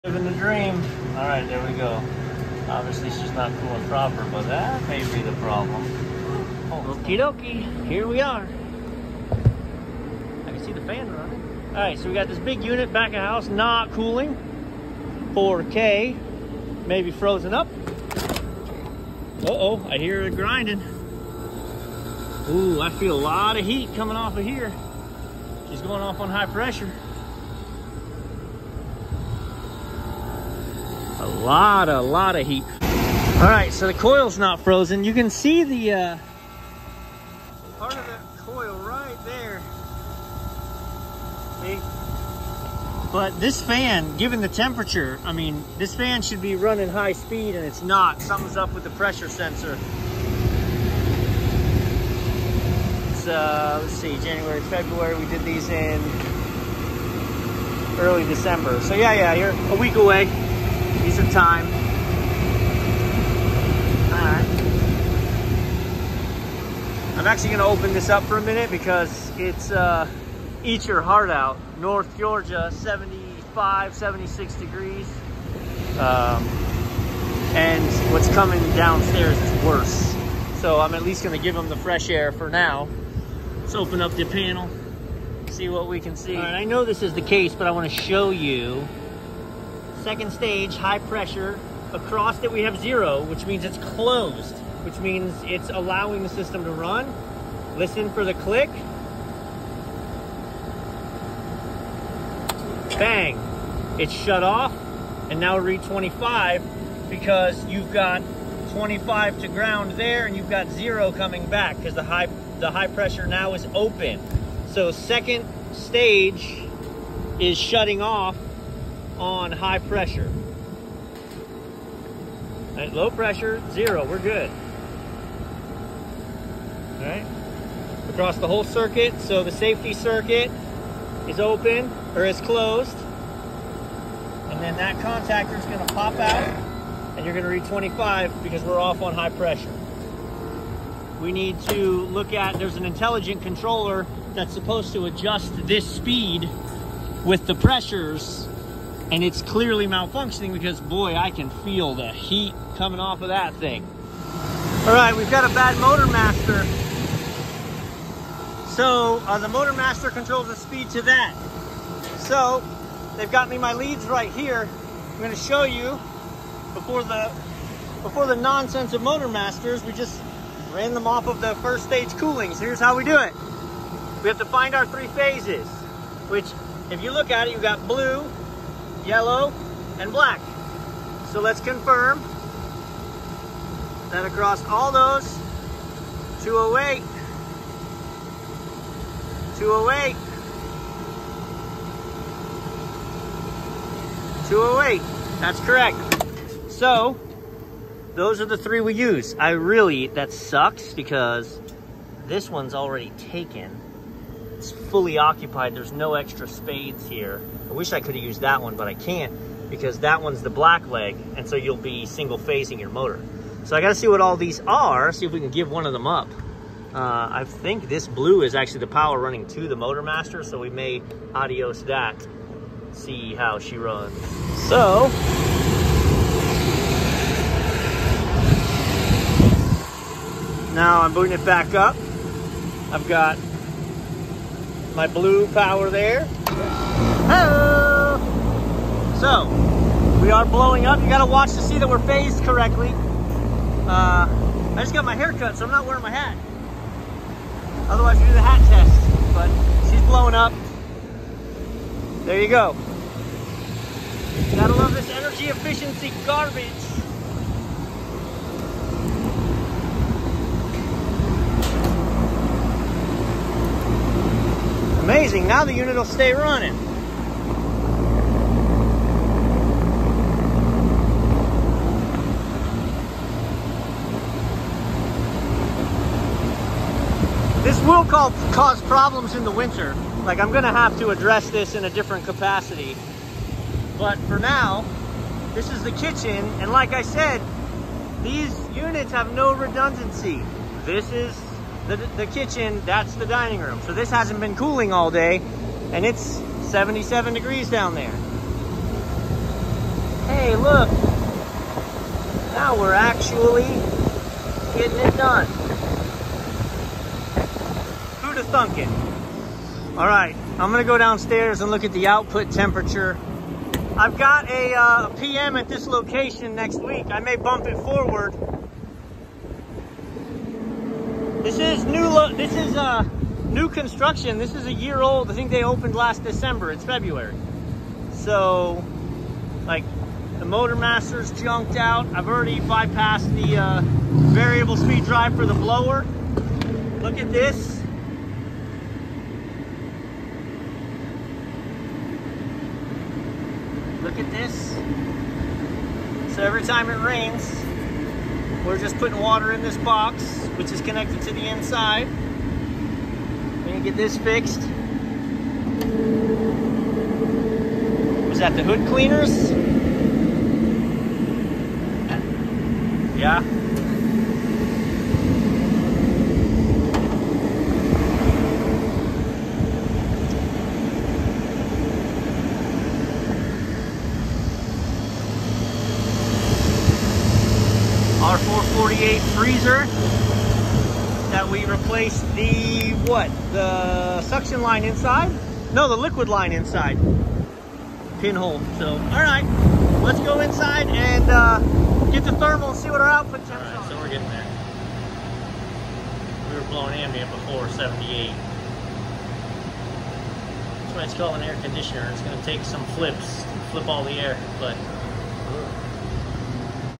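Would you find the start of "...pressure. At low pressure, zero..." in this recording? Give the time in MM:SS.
01:59.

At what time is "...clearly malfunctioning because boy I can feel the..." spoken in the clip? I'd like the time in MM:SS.
02:29.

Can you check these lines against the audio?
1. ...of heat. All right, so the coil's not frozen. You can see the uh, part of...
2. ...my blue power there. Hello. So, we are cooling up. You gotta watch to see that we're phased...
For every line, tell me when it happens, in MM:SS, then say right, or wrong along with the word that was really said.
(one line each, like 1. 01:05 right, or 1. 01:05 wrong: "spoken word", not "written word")
1. 00:32 right
2. 03:54 wrong: "blowing", not "cooling".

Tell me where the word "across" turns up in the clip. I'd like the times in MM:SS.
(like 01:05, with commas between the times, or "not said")
01:31, 02:08, 03:04.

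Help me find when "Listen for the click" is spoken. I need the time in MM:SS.
01:37.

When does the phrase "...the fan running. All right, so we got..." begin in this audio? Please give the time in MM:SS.
00:10.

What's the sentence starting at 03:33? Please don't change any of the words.
So I gotta see what all these are, see if we can give one of them up.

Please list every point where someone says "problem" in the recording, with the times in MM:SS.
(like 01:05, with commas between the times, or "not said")
00:05, 04:38.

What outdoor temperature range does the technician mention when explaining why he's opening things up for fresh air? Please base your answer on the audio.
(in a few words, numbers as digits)
75, 76 degrees.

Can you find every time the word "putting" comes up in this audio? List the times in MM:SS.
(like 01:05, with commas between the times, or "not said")
05:48.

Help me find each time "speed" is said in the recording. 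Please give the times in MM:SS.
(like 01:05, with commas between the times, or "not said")
00:47, 02:25, 02:40, 05:34.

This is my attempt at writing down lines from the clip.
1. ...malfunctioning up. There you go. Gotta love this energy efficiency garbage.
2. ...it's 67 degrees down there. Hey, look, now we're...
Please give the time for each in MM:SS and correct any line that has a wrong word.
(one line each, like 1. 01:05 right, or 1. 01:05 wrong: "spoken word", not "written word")
1. 04:10 wrong: "blowing", not "malfunctioning"
2. 04:56 wrong: "77", not "67".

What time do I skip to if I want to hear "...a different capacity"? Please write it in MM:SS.
04:41.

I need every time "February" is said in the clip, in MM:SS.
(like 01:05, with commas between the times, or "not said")
00:54, 05:26.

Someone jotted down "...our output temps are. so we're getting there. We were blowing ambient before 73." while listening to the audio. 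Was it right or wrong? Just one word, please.
wrong.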